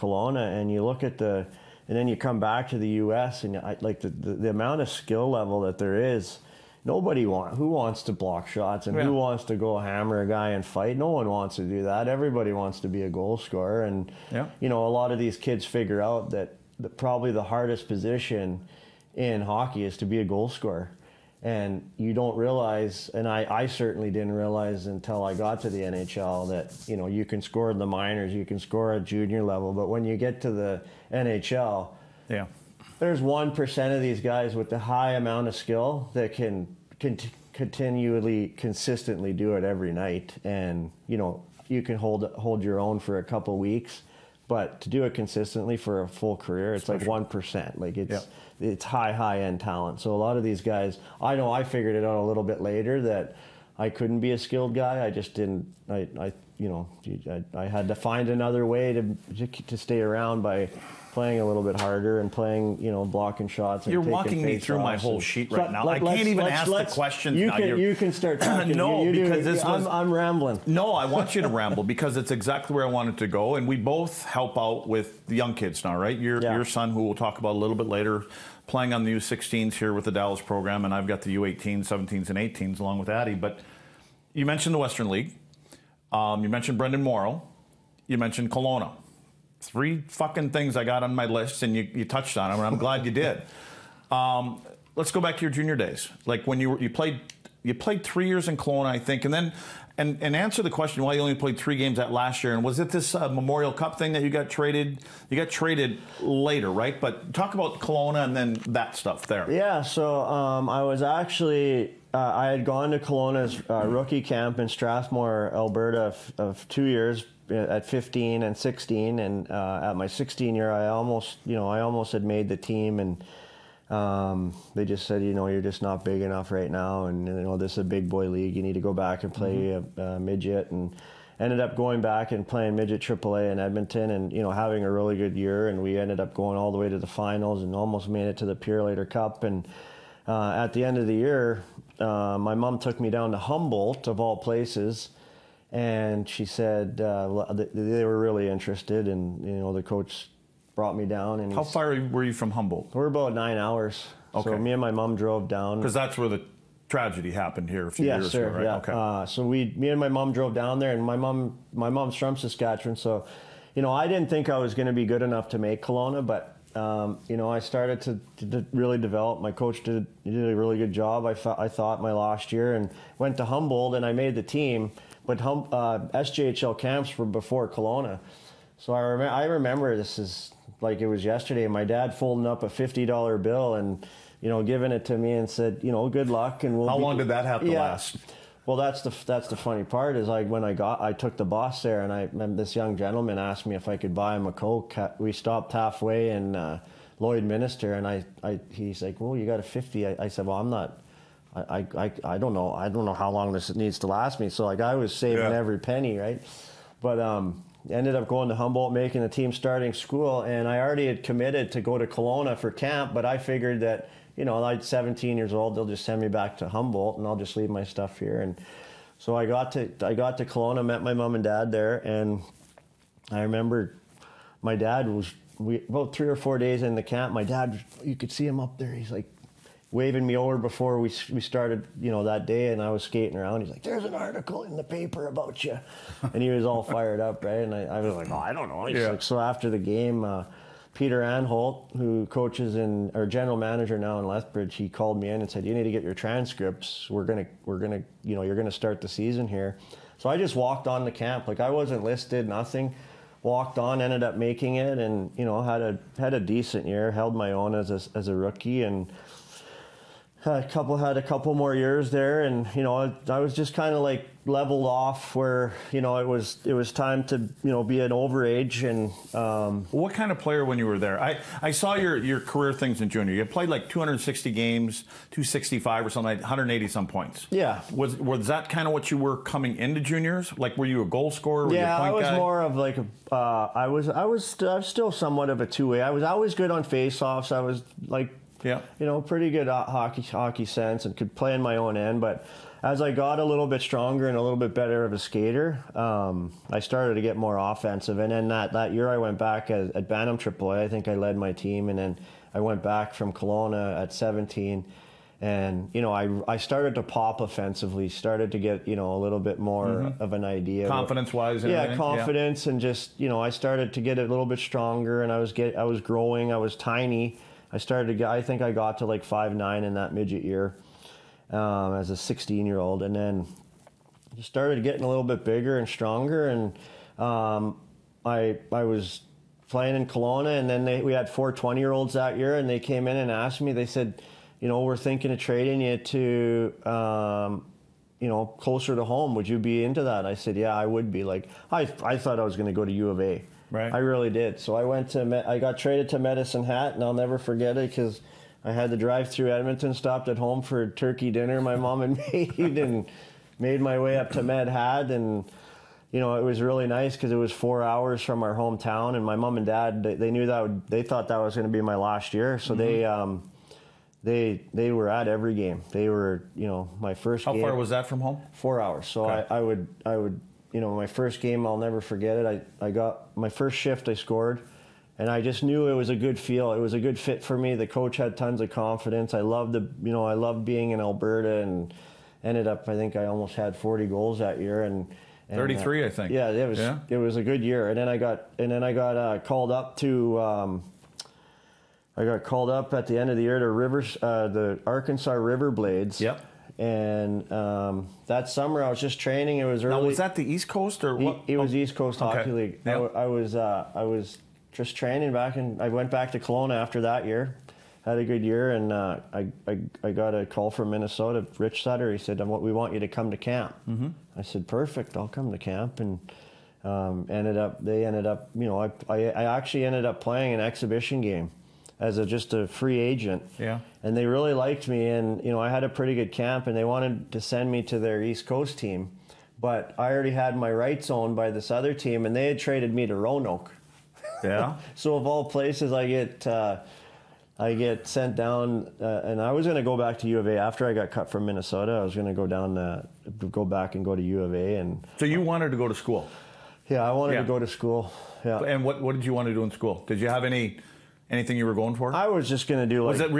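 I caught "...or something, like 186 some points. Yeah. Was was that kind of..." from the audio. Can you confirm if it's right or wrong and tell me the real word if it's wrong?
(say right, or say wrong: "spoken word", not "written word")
wrong: "180", not "186".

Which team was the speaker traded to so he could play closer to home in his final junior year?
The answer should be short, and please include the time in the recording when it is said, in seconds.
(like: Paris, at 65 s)
Medicine Hat, at 346 s.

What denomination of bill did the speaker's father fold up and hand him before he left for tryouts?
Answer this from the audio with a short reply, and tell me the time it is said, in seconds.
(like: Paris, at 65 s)
$50, at 182 s.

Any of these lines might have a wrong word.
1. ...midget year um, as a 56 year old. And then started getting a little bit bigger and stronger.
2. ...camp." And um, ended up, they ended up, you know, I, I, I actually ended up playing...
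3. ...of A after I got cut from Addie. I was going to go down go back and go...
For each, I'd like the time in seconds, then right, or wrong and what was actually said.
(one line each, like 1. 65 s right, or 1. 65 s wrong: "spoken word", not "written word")
1. 320 s wrong: "16", not "56"
2. 415 s right
3. 440 s wrong: "Minnesota", not "Addie".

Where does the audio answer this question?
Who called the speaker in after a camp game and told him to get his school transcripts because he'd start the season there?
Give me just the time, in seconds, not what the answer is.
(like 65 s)
240 s.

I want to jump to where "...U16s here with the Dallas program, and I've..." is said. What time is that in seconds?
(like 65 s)
79 s.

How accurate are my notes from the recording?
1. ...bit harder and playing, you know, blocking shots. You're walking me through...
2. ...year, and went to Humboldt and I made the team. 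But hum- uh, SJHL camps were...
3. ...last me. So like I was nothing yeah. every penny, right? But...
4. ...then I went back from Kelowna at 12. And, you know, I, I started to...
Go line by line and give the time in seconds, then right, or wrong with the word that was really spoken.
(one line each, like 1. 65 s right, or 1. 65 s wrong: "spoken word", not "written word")
1. 61 s right
2. 172 s right
3. 204 s wrong: "saving", not "nothing"
4. 301 s wrong: "17", not "12".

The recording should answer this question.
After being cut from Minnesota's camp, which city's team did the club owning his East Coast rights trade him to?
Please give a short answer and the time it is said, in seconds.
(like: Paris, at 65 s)
Roanoke, at 433 s.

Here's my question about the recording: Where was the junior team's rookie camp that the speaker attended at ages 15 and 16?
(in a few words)
Strathmore, Alberta.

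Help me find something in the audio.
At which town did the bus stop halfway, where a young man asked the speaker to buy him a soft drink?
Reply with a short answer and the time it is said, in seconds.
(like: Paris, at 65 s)
Lloydminster, at 197 s.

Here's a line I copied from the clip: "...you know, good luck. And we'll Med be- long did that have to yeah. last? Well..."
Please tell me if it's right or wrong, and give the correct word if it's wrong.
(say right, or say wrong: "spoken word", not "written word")
wrong: "How", not "Med".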